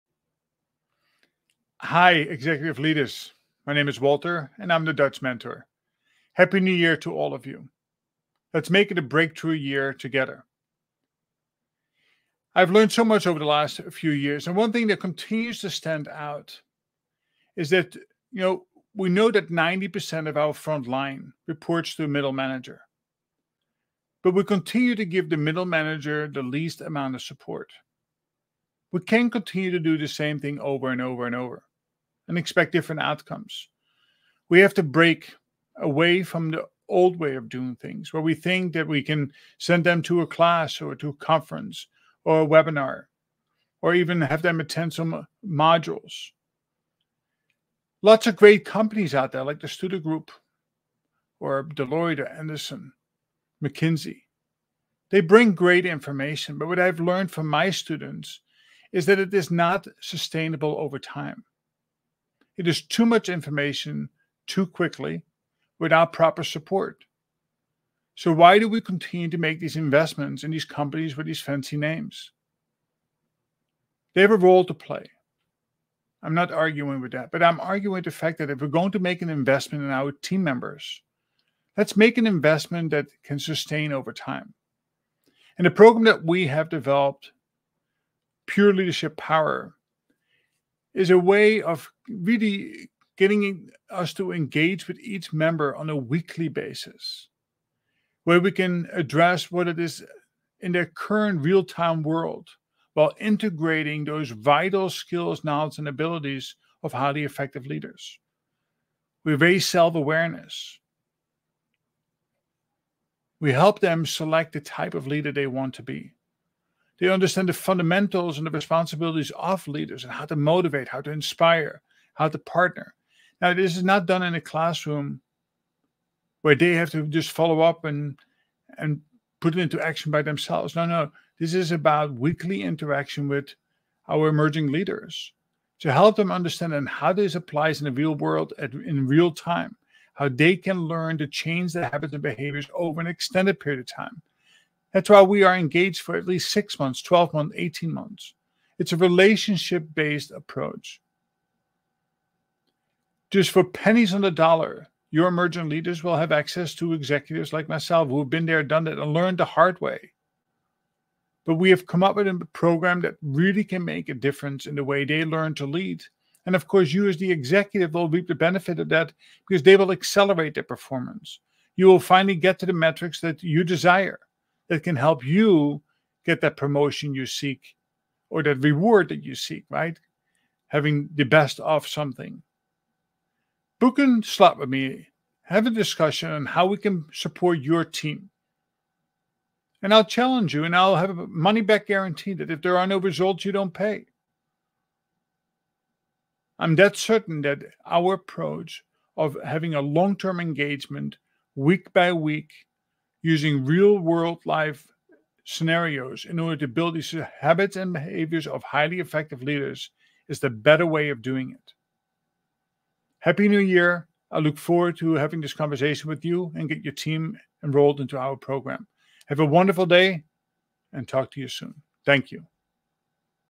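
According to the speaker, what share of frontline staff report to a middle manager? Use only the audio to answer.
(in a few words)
90%.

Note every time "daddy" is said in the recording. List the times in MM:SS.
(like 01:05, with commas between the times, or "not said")
not said.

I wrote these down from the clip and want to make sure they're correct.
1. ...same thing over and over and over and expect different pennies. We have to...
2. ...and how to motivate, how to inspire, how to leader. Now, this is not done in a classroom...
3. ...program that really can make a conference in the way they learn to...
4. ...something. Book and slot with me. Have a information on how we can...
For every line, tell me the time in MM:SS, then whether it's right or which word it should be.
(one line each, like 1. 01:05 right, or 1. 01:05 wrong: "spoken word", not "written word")
1. 00:30 wrong: "outcomes", not "pennies"
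2. 02:00 wrong: "partner", not "leader"
3. 02:42 wrong: "difference", not "conference"
4. 03:01 wrong: "discussion", not "information".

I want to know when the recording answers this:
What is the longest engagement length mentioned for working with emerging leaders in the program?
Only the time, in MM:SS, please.
02:27.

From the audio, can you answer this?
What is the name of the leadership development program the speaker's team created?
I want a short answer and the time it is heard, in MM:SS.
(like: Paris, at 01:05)
Pure Leadership Power, at 01:28.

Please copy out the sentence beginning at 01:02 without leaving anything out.
It is too much information too quickly without proper support.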